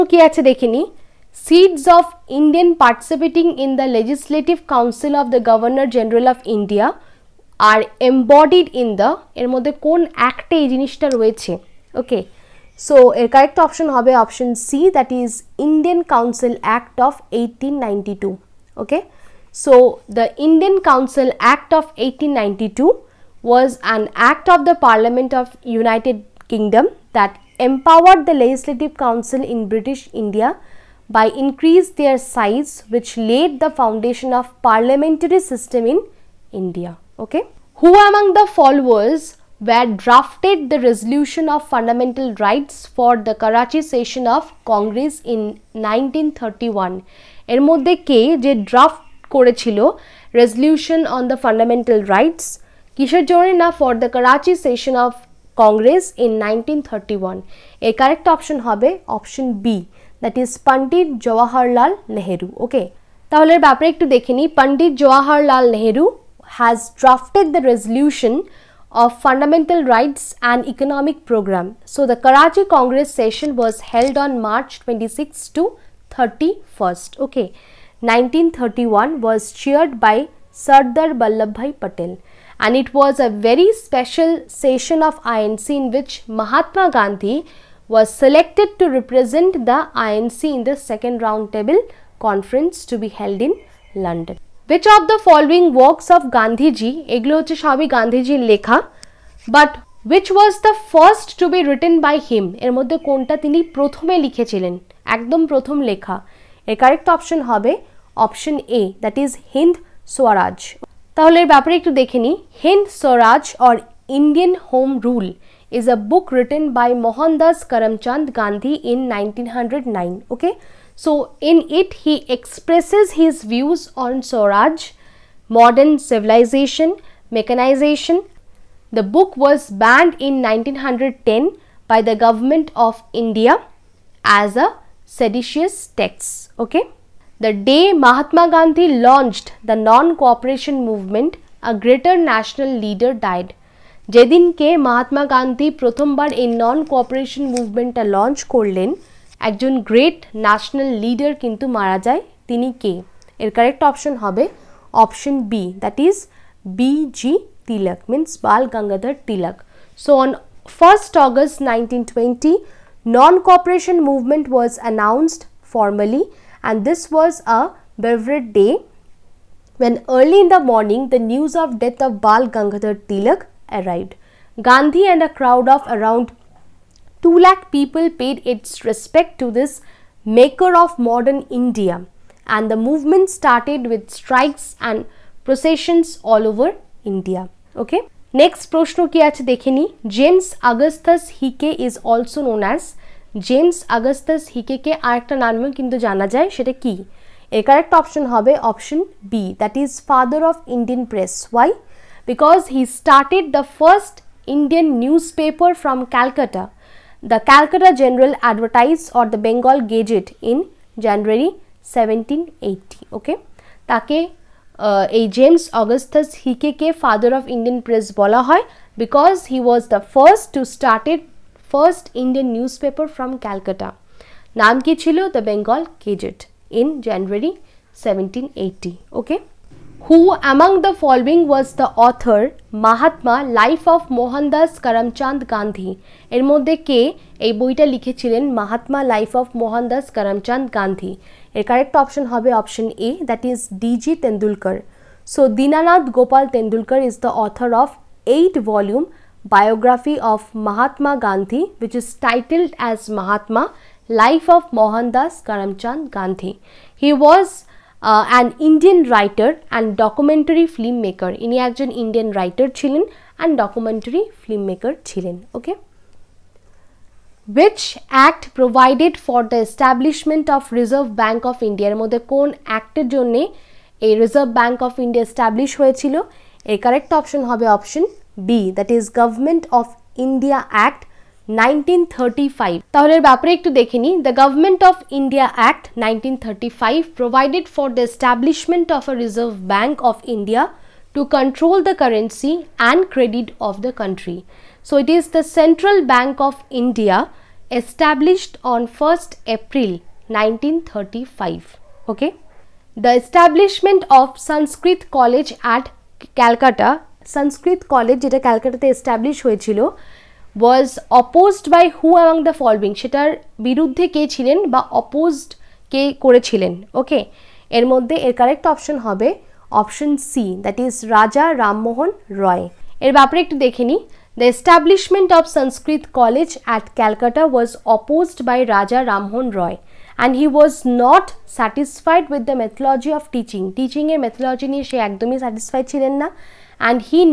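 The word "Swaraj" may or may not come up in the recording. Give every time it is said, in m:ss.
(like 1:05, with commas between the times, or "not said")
2:04.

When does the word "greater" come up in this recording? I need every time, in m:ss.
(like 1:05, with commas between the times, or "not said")
2:21.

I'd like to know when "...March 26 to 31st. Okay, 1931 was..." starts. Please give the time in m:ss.
1:14.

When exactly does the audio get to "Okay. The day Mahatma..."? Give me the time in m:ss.
2:16.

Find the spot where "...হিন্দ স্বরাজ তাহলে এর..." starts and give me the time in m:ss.
1:49.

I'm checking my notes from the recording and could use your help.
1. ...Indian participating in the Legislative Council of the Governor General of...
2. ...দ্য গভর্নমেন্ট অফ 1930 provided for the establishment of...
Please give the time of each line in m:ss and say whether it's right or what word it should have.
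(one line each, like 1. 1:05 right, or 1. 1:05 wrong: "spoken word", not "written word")
1. 0:02 right
2. 4:44 wrong: "1935", not "1930".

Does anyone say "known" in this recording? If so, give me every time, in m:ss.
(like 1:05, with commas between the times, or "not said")
3:12.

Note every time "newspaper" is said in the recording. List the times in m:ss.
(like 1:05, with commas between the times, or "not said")
3:24, 3:42.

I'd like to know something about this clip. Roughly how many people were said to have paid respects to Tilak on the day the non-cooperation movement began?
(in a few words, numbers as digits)
2 lakh.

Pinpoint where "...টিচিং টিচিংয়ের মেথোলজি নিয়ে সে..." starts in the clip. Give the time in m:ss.
5:33.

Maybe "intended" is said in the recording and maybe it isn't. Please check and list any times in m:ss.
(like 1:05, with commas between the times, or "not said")
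not said.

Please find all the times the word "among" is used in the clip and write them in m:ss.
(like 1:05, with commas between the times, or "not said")
0:38, 3:50.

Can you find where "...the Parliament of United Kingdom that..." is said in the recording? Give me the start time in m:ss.
0:24.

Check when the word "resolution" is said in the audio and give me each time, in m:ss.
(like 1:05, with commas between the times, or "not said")
0:40, 1:07.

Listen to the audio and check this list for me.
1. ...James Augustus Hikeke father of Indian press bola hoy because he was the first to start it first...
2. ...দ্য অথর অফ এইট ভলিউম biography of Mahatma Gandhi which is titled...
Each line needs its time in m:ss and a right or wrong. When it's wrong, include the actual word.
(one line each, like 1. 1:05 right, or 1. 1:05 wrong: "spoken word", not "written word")
1. 3:35 right
2. 4:07 right.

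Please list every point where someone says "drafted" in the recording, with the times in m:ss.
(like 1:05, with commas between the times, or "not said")
0:40, 1:07.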